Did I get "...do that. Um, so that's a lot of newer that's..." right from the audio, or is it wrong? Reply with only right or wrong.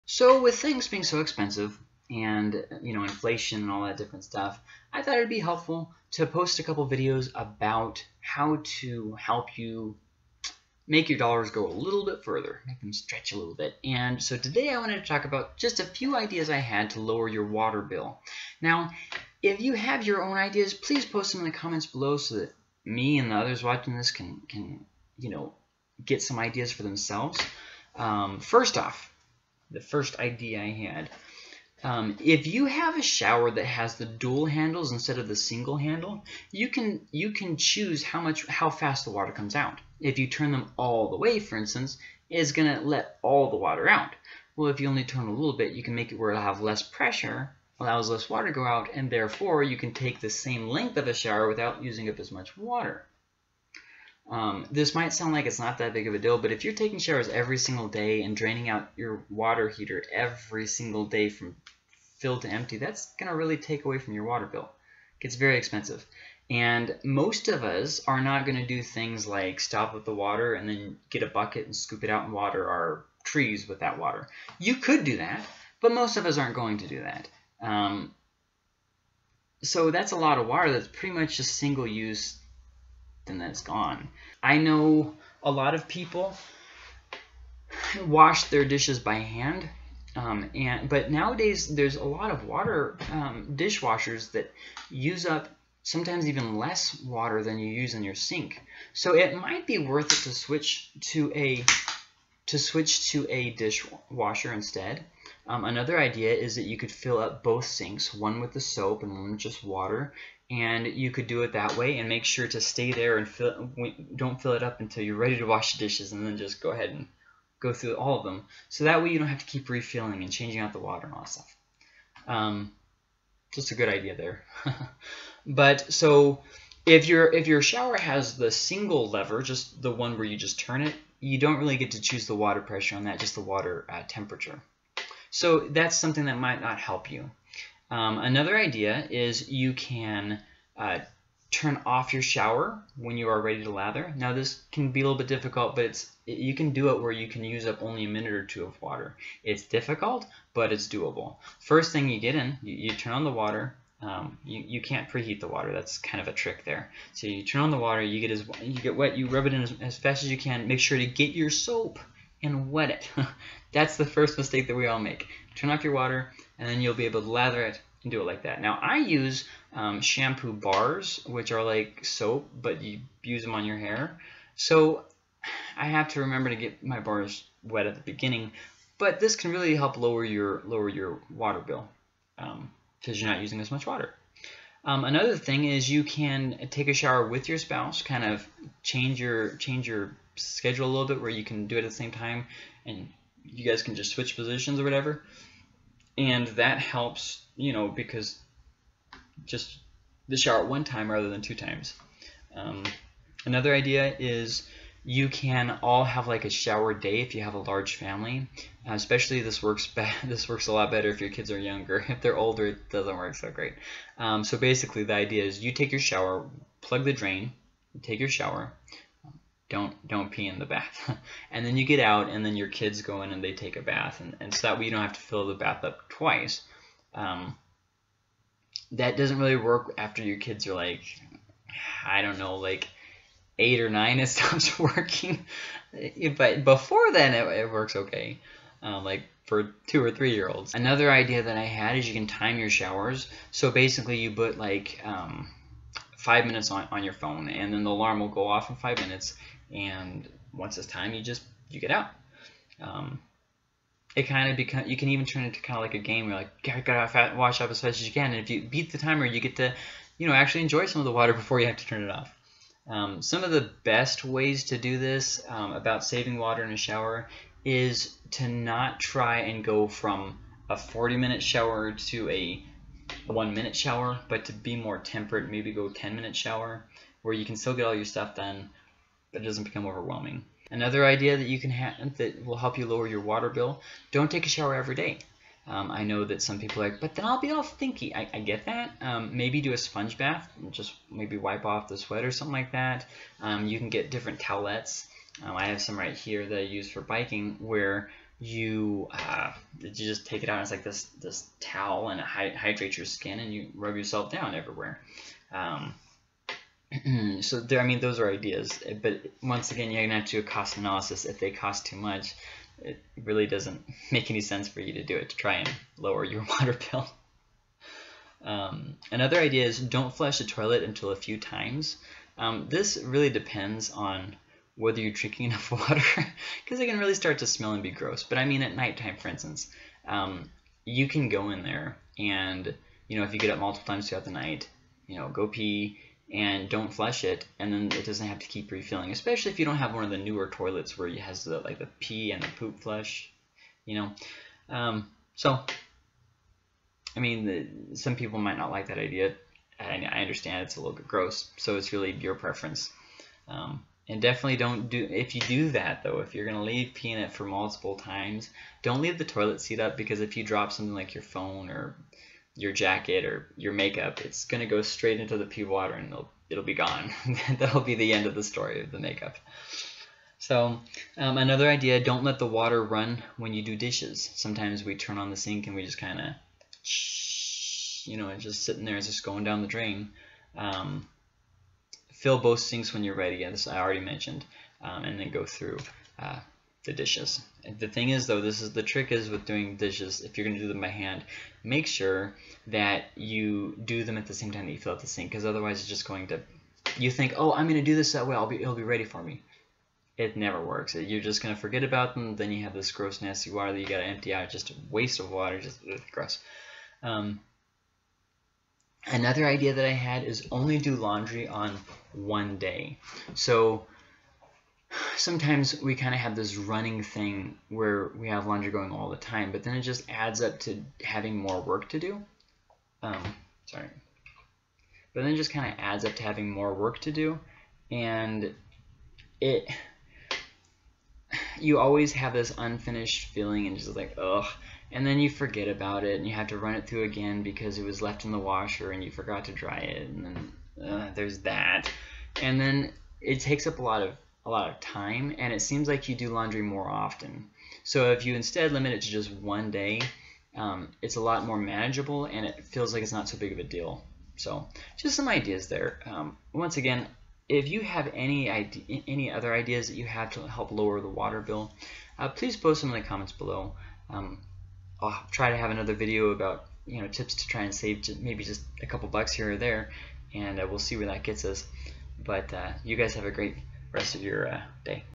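wrong.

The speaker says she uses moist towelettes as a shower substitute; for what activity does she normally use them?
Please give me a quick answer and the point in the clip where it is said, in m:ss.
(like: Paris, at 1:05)
biking, at 4:57.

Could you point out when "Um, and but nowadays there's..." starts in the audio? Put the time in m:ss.
1:30.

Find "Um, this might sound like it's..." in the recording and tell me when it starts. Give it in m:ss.
0:54.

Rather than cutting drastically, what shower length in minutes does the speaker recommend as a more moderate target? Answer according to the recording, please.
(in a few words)
10.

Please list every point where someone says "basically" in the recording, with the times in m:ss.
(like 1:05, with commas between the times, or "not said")
3:34, 4:03.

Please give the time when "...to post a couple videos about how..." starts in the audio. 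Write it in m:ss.
0:06.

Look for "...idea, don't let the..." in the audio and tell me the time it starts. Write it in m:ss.
6:11.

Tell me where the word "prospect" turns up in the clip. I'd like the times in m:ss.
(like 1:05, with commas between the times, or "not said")
not said.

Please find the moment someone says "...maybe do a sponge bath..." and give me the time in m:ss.
4:49.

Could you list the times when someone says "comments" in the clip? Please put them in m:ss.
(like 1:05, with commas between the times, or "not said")
0:21, 7:43.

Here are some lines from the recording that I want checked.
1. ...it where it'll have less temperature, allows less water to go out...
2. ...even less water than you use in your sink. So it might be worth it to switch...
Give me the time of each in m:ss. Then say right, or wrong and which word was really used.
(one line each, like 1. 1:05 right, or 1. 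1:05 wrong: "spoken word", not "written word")
1. 0:46 wrong: "pressure", not "temperature"
2. 1:36 right.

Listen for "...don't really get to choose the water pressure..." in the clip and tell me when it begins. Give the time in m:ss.
2:11.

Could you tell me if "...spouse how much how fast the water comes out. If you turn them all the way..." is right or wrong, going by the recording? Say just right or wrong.
wrong.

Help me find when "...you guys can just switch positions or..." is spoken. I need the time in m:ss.
3:13.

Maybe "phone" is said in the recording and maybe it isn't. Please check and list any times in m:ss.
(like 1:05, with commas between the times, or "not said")
4:07, 6:01.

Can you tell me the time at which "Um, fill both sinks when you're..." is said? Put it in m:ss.
6:20.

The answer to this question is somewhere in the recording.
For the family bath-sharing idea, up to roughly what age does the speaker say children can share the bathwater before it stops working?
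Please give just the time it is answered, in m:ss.
3:53.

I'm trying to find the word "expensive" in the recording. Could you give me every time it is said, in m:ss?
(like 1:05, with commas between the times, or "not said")
0:01, 1:05.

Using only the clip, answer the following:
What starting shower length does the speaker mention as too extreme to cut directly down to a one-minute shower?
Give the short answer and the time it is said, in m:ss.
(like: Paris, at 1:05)
40 minutes, at 4:30.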